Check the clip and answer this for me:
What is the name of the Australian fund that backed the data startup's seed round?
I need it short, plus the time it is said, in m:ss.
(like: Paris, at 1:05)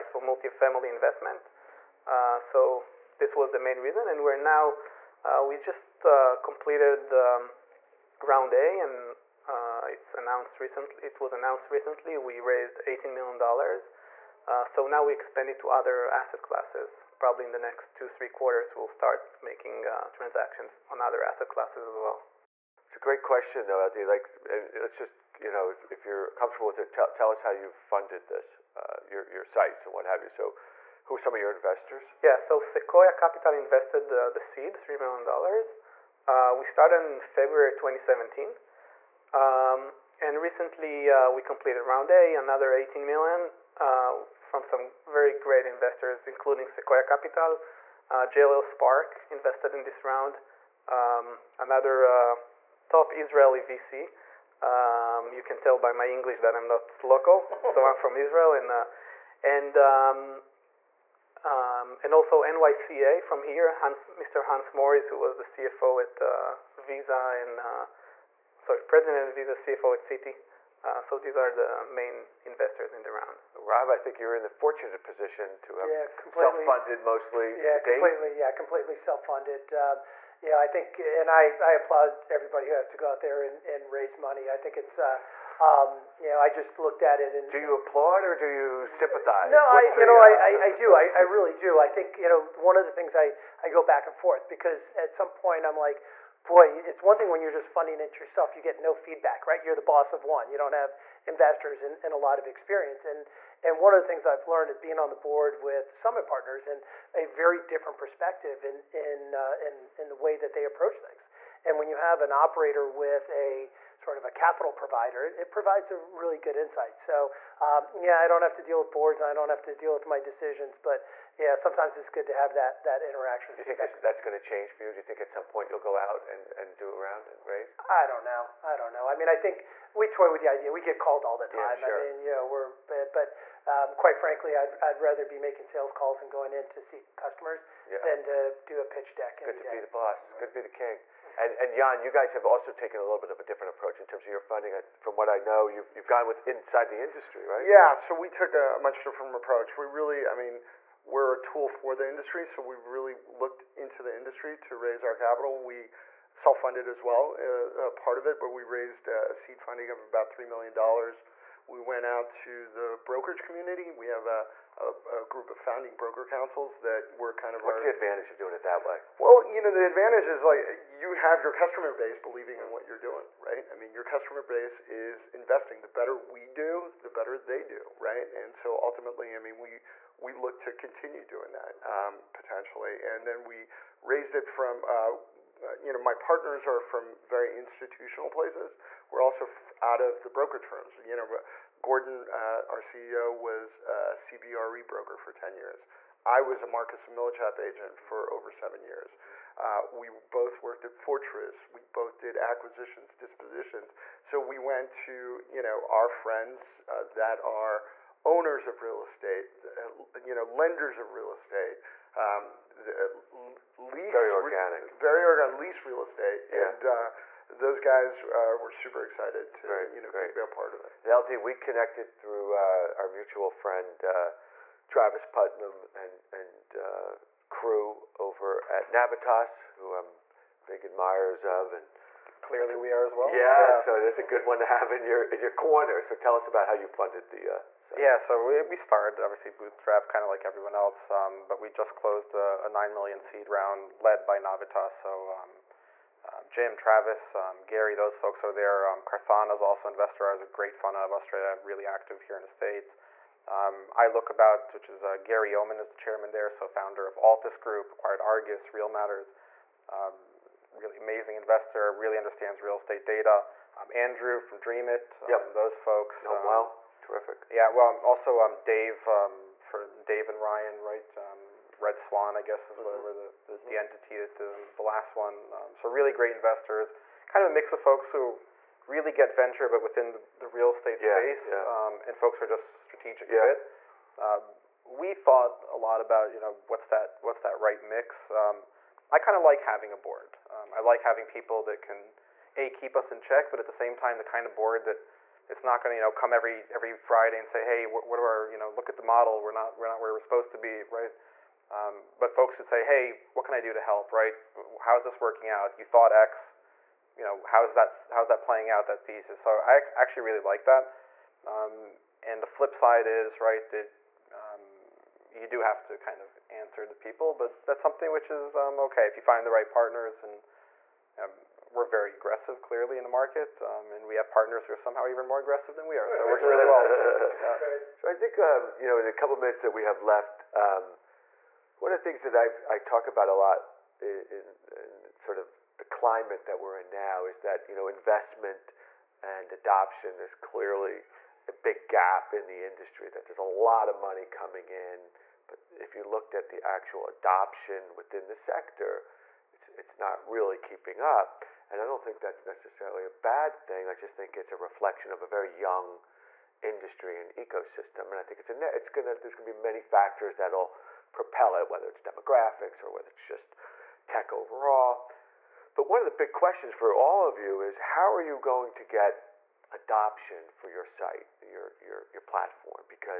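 Carthona, at 4:09.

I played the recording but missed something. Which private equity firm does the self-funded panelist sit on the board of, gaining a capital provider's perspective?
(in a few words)
Summit Partners.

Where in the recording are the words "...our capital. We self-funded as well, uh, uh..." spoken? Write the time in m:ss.
2:35.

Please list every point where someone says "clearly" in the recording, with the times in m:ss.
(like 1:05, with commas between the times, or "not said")
3:52, 5:22, 5:40.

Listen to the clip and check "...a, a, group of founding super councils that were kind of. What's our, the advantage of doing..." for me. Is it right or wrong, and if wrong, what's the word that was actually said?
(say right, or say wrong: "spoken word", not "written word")
wrong: "broker", not "super".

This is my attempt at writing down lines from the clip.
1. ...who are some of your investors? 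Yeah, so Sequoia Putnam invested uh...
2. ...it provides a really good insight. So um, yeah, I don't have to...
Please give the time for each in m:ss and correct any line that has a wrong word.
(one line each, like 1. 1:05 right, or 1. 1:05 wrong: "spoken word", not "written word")
1. 0:31 wrong: "Capital", not "Putnam"
2. 1:55 right.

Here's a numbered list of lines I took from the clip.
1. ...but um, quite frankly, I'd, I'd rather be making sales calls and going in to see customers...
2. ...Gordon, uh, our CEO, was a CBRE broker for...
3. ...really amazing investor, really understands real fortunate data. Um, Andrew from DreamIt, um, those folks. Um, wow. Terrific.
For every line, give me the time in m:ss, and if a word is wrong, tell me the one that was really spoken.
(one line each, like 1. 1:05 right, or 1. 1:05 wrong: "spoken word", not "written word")
1. 2:13 right
2. 3:11 right
3. 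4:20 wrong: "estate", not "fortunate".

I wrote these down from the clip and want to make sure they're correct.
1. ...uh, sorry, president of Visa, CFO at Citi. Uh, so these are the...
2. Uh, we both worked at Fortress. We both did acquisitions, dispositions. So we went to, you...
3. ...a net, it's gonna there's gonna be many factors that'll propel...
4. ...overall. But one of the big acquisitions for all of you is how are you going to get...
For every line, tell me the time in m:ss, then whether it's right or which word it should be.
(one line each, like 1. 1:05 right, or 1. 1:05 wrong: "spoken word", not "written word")
1. 1:07 right
2. 3:19 right
3. 5:58 right
4. 6:04 wrong: "questions", not "acquisitions".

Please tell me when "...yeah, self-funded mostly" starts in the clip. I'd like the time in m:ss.
1:15.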